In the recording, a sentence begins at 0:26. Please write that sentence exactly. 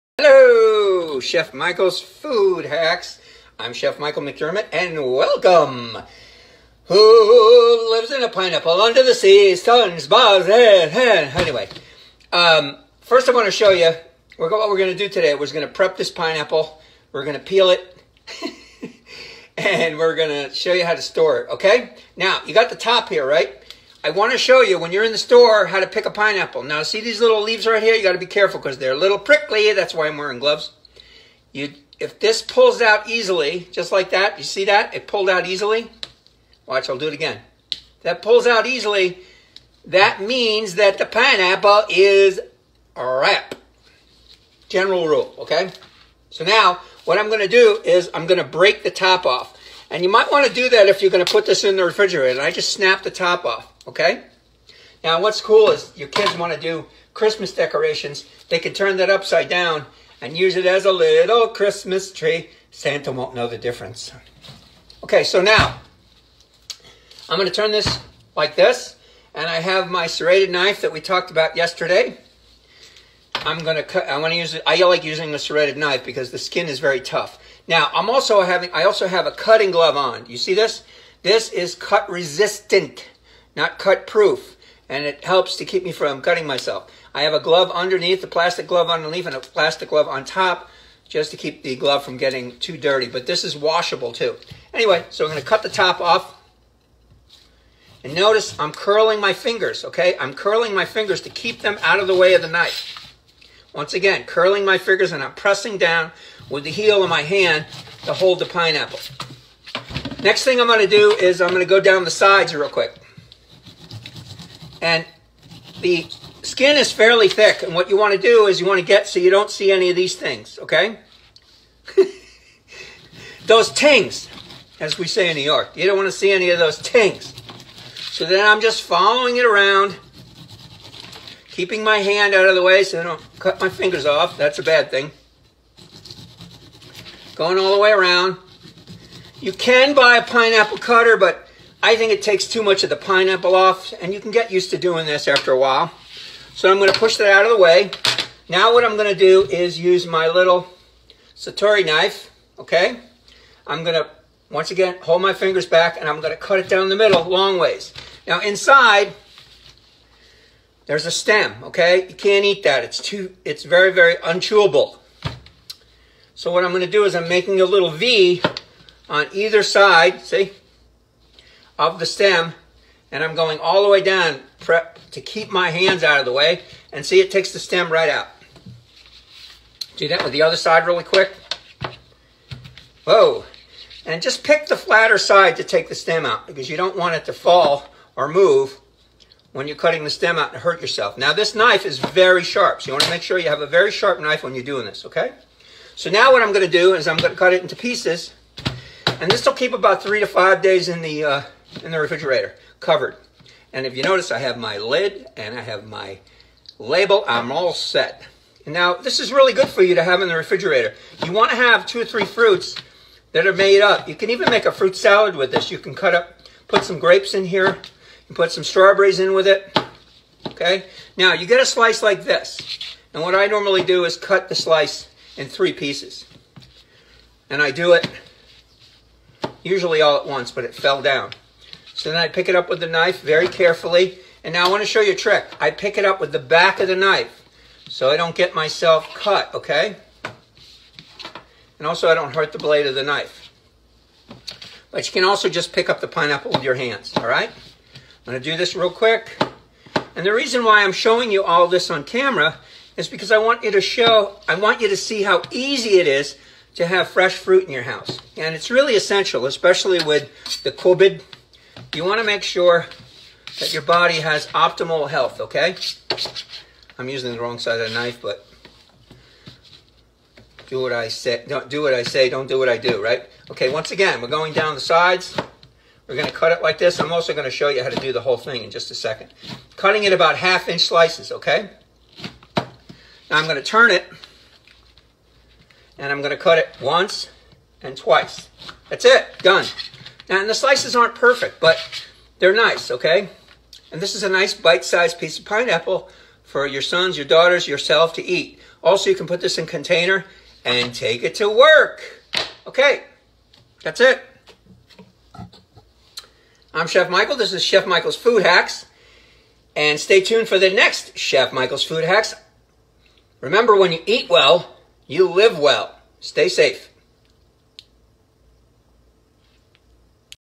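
Now, see these little leaves right here?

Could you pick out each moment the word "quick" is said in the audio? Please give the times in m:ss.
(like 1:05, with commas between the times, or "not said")
1:52, 3:01, 4:08.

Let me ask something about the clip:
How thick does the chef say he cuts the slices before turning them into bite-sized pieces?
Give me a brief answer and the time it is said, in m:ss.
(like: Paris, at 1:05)
Half inch, at 4:40.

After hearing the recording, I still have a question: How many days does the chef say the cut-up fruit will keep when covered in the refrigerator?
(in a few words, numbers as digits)
3 to 5 days.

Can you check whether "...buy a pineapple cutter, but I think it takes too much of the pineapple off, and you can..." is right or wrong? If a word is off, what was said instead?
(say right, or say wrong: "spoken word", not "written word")
right.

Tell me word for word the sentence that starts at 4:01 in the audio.
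And also I don't hurt the blade of the knife.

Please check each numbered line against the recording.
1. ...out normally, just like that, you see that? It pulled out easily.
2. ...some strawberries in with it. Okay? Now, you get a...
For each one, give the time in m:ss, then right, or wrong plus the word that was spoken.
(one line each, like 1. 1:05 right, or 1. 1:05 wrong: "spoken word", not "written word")
1. 0:32 wrong: "easily", not "normally"
2. 3:38 right.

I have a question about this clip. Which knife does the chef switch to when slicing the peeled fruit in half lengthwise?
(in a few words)
Santoku knife.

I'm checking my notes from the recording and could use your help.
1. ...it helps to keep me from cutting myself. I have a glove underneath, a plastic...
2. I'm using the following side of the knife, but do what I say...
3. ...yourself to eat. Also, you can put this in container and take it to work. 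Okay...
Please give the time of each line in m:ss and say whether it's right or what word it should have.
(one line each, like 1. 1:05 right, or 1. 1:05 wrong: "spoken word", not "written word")
1. 1:25 right
2. 4:26 wrong: "wrong", not "following"
3. 4:57 right.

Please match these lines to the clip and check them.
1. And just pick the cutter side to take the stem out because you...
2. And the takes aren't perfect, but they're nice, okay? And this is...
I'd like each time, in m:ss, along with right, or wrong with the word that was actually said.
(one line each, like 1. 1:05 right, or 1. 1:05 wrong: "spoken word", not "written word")
1. 3:04 wrong: "flatter", not "cutter"
2. 4:50 wrong: "slices", not "takes".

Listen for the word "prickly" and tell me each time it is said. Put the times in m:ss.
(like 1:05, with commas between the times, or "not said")
0:29.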